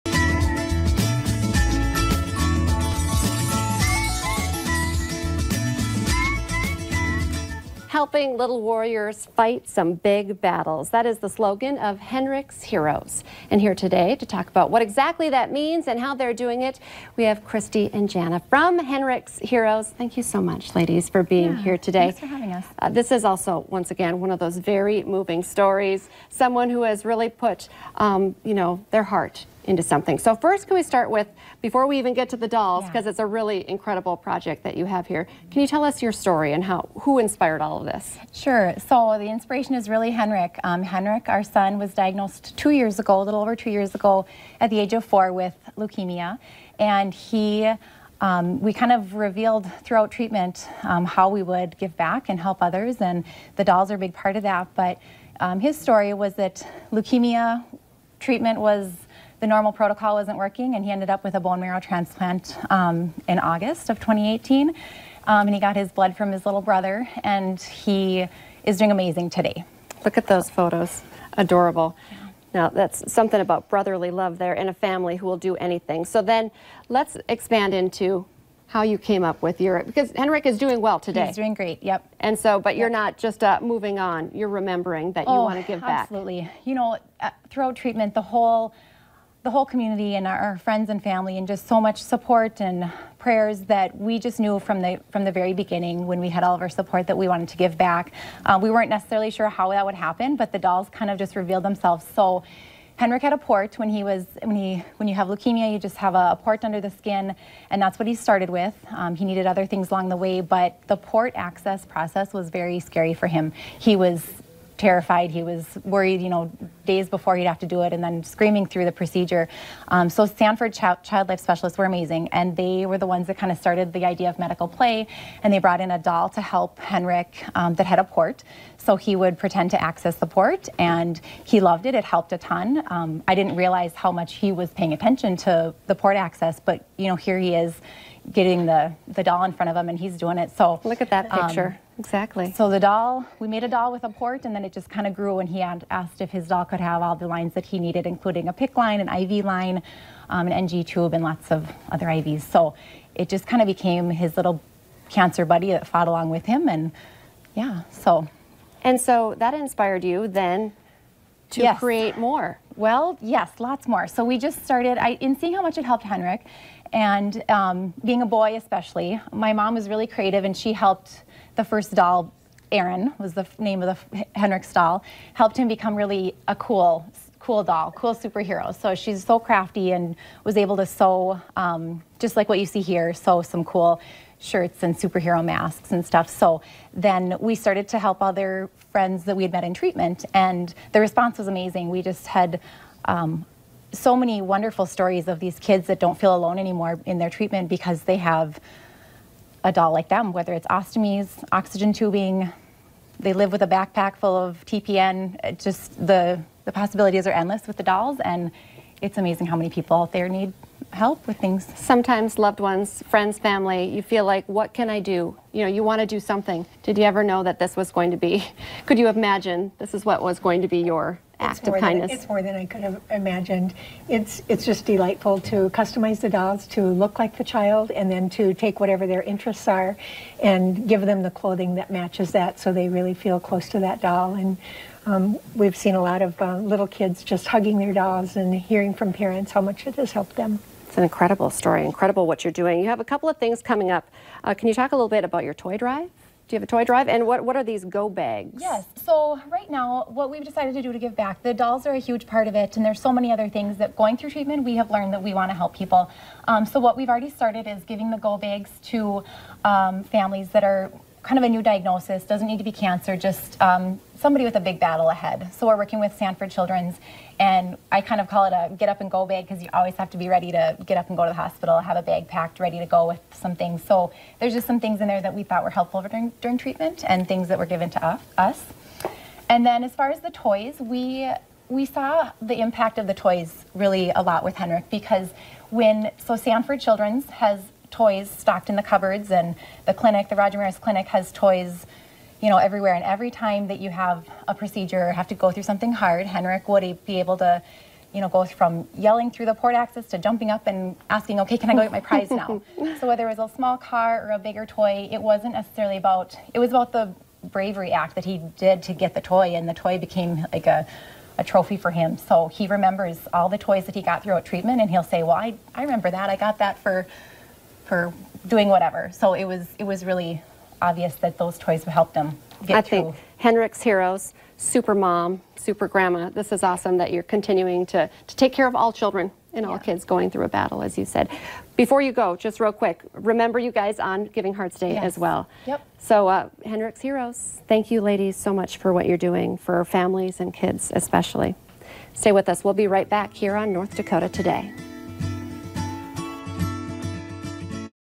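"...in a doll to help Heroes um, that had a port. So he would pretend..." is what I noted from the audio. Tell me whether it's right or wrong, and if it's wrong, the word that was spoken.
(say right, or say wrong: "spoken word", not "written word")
wrong: "Henrik", not "Heroes".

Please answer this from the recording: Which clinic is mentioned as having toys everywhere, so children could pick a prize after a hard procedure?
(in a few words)
Roger Maris Clinic.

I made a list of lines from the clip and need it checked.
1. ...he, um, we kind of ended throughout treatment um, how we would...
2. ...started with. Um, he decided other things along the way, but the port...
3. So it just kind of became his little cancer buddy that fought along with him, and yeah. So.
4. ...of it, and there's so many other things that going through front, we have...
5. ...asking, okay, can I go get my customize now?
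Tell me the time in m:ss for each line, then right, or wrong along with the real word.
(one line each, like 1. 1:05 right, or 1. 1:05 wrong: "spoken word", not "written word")
1. 0:47 wrong: "revealed", not "ended"
2. 1:48 wrong: "needed", not "decided"
3. 2:32 right
4. 4:12 wrong: "treatment", not "front"
5. 5:01 wrong: "prize", not "customize".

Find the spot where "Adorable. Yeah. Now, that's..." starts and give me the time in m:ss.
1:11.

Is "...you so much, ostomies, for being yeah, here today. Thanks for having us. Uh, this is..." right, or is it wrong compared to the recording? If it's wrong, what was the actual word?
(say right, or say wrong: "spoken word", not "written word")
wrong: "ladies", not "ostomies".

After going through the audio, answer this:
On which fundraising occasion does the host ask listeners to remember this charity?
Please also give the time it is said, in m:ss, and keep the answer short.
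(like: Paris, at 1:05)
Giving Hearts Day, at 5:34.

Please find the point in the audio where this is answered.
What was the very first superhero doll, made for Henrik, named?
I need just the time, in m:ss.
2:52.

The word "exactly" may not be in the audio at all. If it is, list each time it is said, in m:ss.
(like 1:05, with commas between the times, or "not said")
0:14, 2:22.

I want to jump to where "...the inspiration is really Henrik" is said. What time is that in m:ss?
0:39.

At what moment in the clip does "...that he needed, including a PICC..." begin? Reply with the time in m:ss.
2:27.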